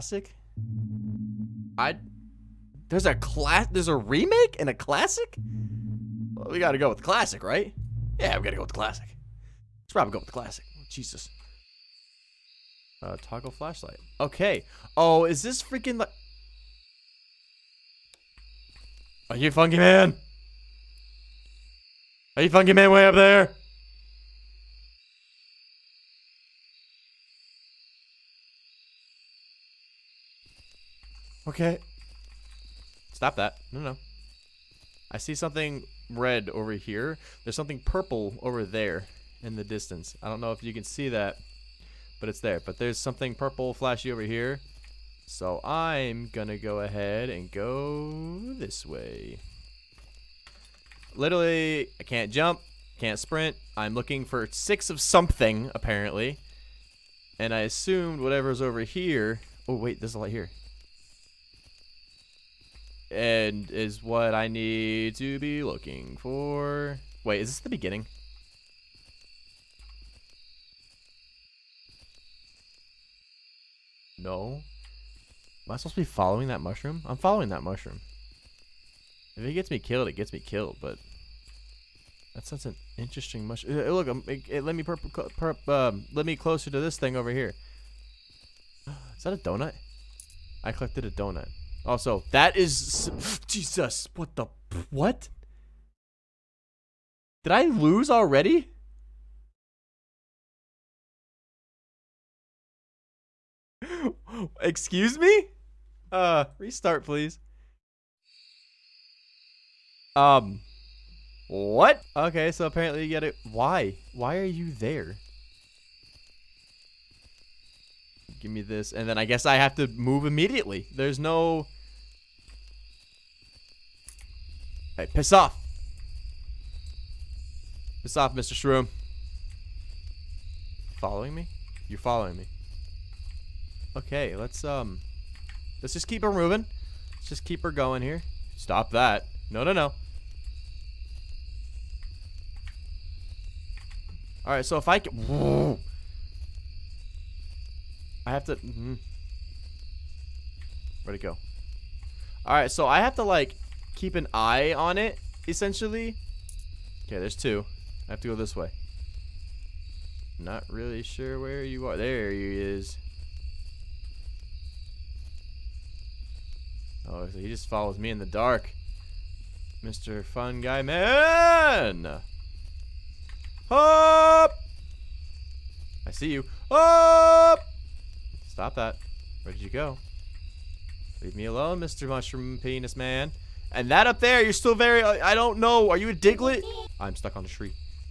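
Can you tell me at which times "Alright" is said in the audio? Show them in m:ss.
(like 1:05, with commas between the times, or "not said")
2:24, 2:32.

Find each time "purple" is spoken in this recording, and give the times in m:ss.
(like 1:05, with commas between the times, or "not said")
0:37, 0:43.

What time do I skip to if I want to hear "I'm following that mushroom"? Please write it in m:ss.
1:17.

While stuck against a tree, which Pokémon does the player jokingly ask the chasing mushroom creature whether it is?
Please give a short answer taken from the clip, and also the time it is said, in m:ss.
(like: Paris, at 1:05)
Diglett, at 3:06.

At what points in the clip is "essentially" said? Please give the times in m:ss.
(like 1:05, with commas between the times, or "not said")
2:35.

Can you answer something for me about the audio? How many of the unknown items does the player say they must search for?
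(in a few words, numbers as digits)
6.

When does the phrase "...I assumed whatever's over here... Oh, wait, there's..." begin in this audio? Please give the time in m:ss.
0:57.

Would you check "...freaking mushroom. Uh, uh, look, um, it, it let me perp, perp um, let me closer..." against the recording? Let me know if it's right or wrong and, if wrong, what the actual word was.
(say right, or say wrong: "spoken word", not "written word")
wrong: "interesting", not "freaking".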